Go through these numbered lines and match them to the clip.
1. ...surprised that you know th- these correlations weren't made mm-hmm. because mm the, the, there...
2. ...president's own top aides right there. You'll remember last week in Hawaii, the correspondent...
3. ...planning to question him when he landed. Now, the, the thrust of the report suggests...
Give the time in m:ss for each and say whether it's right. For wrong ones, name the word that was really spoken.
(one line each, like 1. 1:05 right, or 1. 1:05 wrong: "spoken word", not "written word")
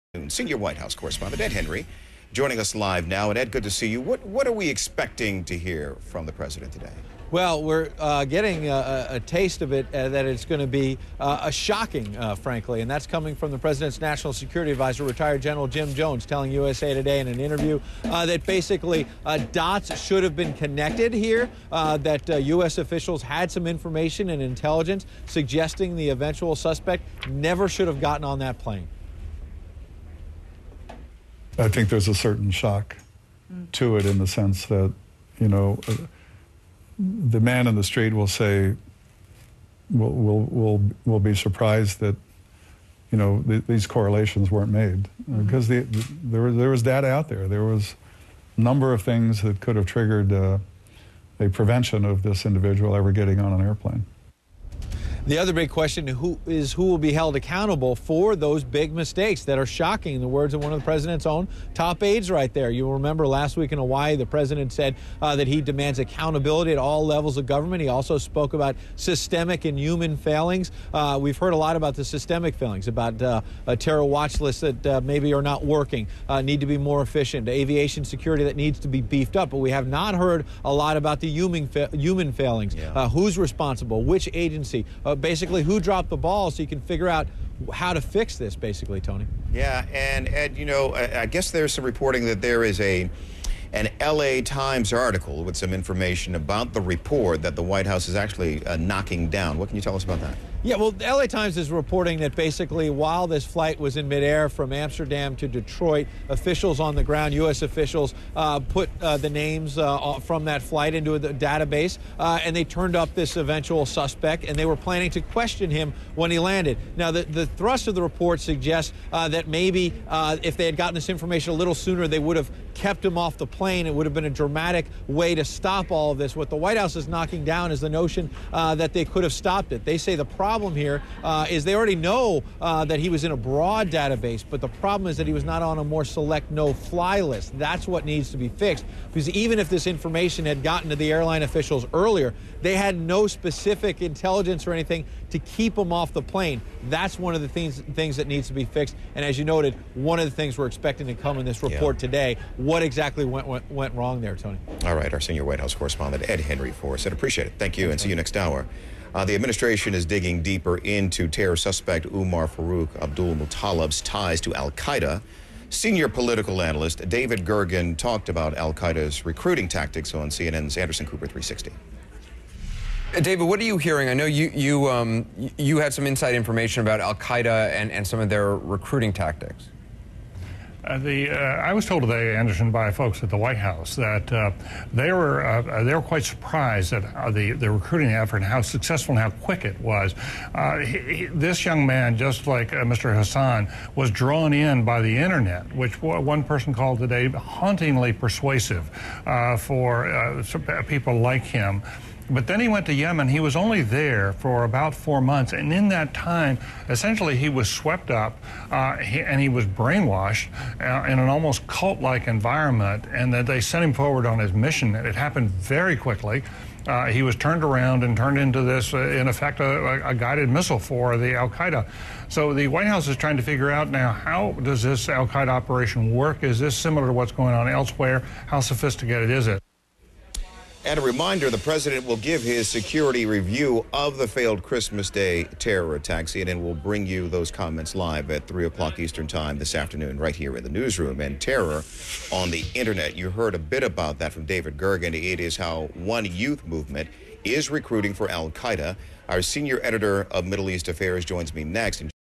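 1. 0:41 right
2. 1:00 wrong: "president", not "correspondent"
3. 1:54 right.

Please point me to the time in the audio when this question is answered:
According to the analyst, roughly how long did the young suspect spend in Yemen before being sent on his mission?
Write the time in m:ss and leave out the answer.
3:24.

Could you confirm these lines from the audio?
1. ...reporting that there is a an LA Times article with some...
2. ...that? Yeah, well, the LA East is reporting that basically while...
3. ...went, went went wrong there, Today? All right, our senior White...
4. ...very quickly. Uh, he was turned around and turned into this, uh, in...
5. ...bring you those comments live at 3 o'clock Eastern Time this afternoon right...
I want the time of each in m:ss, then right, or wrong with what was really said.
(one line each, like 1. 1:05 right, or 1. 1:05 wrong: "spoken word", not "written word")
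1. 1:31 right
2. 1:40 wrong: "Times", not "East"
3. 2:33 wrong: "Tony", not "Today"
4. 3:35 right
5. 3:56 right.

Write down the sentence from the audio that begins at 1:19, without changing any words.
But we have not heard a lot about the human, fa human failings.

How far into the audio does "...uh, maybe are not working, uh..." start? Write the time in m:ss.
1:14.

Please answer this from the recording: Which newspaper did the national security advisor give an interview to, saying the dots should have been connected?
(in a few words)
USA Today.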